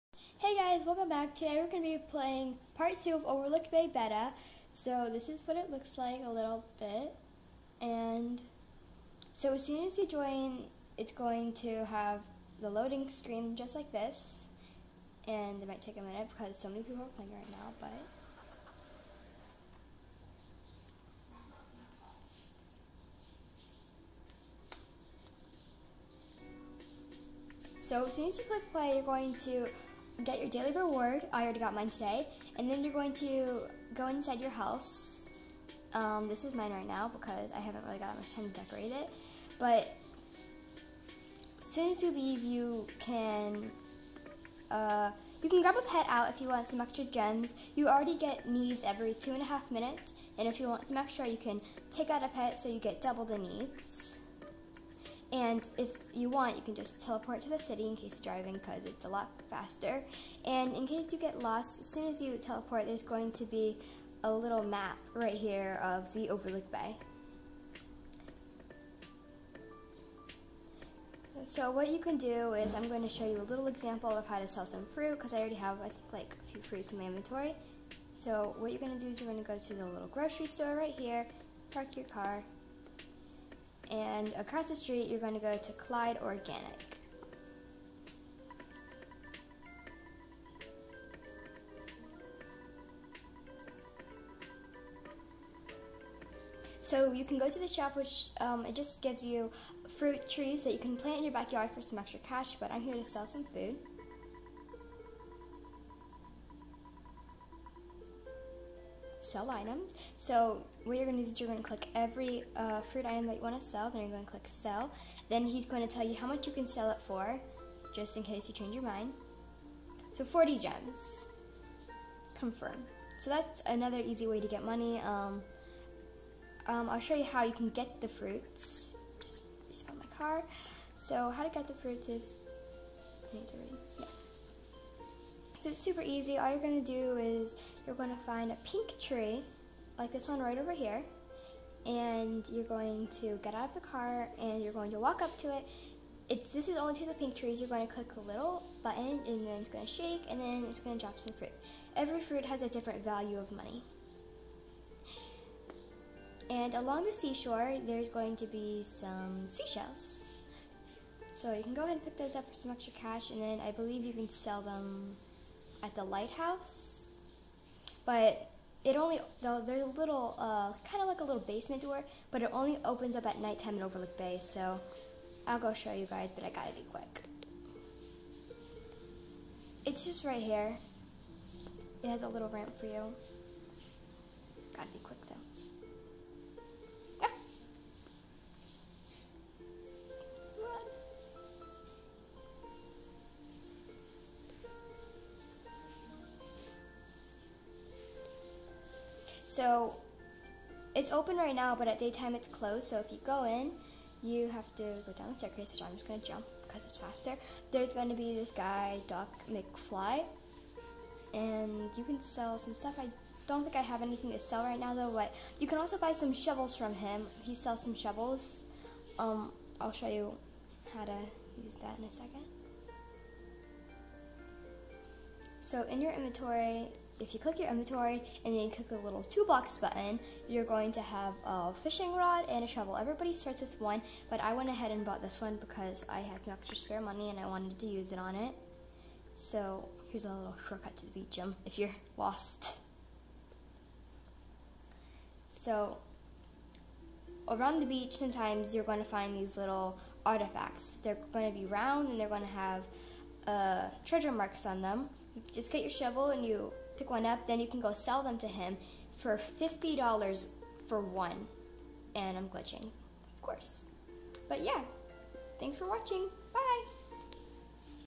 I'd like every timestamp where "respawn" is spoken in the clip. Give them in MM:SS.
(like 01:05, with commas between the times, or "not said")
02:09.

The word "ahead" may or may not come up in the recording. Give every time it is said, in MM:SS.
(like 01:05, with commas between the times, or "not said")
02:41, 03:54.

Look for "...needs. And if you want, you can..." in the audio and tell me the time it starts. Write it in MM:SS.
00:53.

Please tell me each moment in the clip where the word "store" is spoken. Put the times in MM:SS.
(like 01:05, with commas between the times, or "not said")
01:20.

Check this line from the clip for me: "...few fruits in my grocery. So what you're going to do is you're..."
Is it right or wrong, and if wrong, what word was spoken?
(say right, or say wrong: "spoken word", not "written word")
wrong: "inventory", not "grocery".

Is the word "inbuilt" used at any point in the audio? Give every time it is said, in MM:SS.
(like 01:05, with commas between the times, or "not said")
not said.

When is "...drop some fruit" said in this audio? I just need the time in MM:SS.
02:31.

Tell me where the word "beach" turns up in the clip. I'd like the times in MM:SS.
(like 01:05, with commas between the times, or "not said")
04:01, 04:07.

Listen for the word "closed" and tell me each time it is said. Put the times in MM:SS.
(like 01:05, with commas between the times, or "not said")
03:22.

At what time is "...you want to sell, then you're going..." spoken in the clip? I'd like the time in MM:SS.
01:53.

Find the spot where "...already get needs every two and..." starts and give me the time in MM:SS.
00:47.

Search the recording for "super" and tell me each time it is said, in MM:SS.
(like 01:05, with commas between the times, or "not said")
02:15.